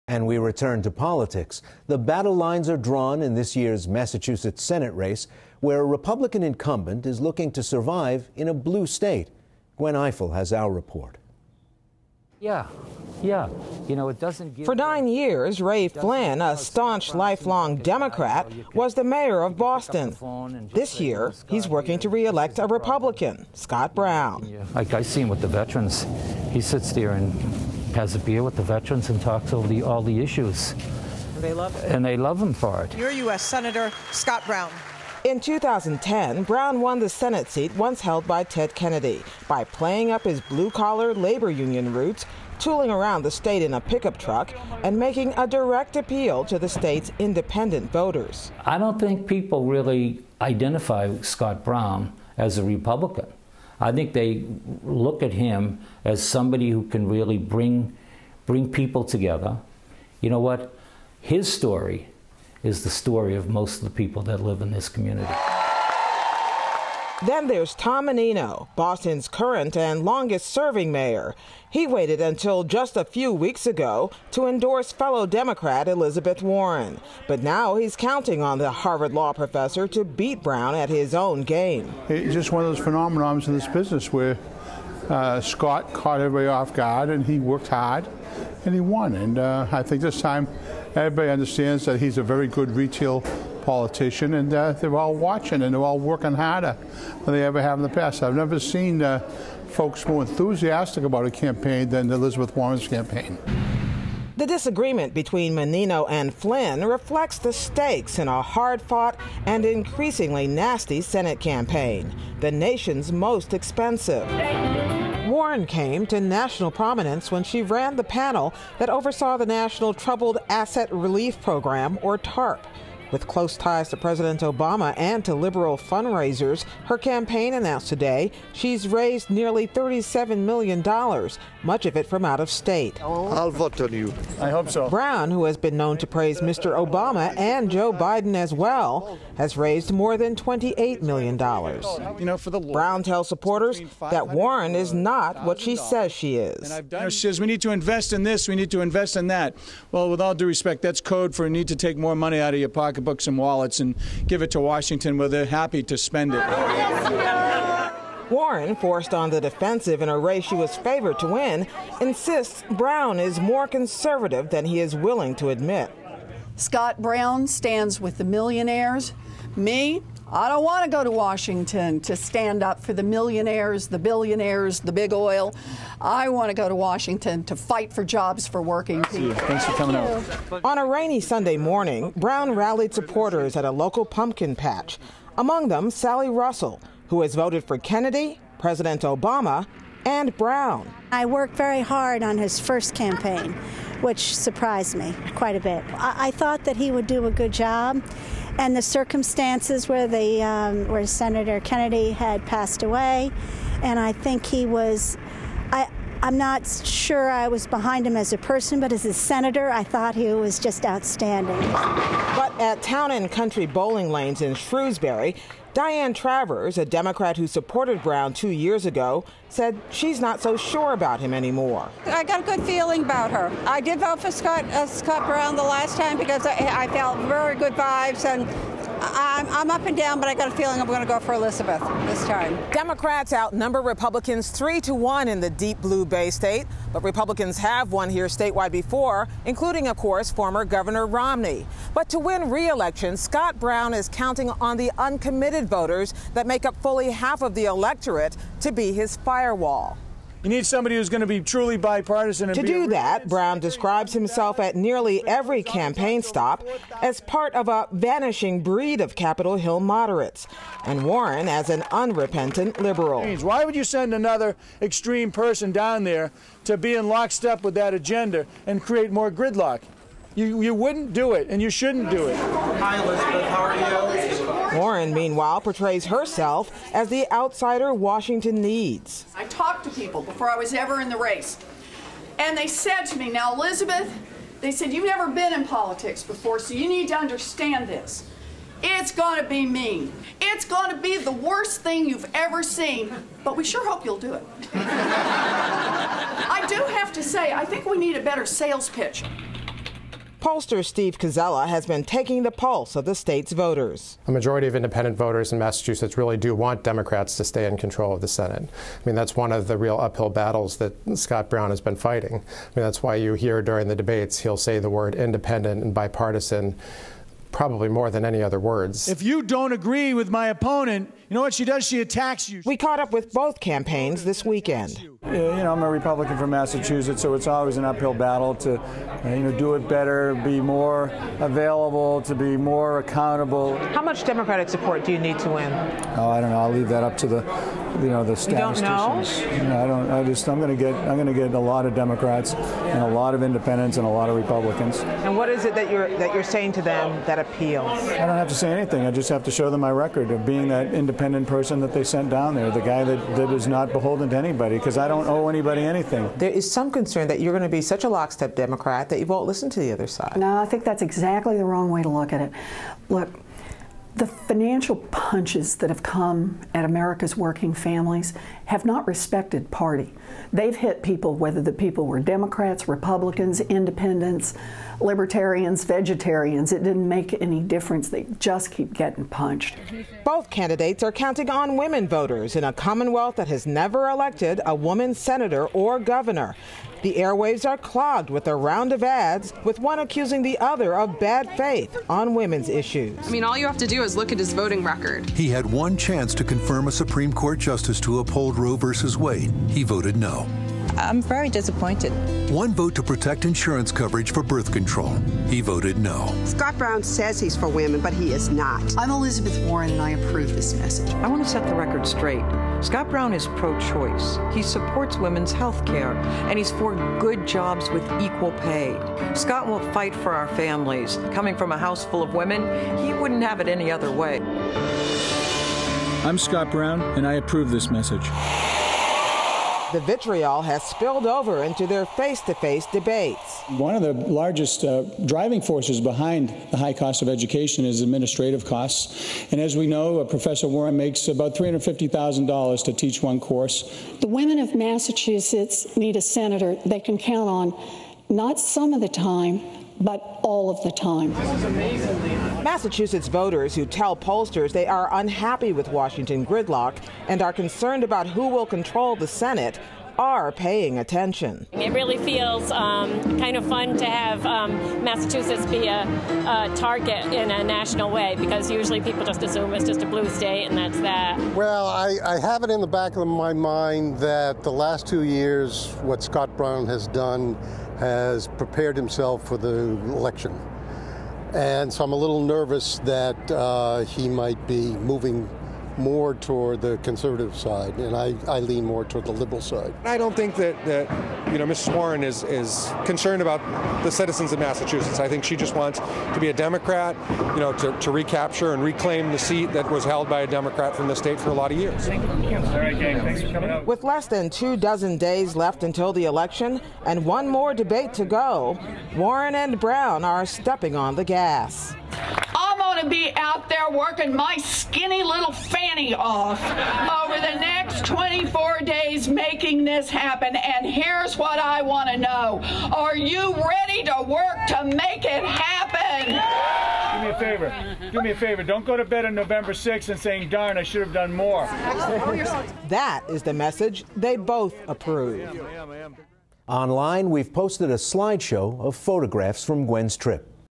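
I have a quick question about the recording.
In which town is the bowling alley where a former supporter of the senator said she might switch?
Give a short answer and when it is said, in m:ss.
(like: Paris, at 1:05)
Shrewsbury, at 3:34.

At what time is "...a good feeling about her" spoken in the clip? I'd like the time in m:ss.
3:42.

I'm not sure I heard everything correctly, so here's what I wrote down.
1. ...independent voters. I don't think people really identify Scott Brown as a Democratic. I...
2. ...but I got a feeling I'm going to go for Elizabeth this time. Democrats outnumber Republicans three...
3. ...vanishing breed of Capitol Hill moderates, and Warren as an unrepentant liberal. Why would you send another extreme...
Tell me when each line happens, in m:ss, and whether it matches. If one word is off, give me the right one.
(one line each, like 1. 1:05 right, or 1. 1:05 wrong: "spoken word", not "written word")
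1. 0:47 wrong: "Republican", not "Democratic"
2. 3:50 right
3. 4:17 right.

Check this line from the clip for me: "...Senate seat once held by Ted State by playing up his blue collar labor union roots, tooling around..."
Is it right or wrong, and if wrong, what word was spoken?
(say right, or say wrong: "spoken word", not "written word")
wrong: "Kennedy", not "State".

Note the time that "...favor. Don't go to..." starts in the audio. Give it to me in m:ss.
8:48.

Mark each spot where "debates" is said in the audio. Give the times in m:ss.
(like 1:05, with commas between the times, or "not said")
5:13, 7:12, 8:27.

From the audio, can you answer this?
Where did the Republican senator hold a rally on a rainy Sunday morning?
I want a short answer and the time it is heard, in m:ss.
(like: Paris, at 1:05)
pumpkin patch, at 3:04.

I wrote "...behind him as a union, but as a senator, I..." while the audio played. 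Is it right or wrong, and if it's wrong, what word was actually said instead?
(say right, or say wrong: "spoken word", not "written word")
wrong: "person", not "union".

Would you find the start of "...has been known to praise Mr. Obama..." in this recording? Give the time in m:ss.
2:15.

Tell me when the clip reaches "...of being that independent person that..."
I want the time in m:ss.
5:50.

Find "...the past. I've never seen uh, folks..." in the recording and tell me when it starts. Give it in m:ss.
1:37.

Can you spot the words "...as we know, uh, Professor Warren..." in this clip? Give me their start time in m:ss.
7:19.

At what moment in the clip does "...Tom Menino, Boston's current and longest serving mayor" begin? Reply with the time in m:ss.
1:07.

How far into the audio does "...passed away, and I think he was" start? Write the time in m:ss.
3:22.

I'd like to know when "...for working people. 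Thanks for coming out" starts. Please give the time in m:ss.
2:58.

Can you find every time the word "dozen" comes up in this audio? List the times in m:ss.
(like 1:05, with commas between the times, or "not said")
8:24.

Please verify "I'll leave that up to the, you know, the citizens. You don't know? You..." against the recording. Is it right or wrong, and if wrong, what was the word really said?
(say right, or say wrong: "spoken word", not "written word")
wrong: "statisticians", not "citizens".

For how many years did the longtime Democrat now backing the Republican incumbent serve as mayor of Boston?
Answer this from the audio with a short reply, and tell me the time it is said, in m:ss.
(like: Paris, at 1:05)
9, at 0:14.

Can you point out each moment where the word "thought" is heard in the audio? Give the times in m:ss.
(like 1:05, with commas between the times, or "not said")
3:16, 3:29.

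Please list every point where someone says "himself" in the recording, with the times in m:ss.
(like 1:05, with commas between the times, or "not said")
4:14, 7:58.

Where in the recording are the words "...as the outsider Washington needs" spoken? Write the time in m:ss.
4:36.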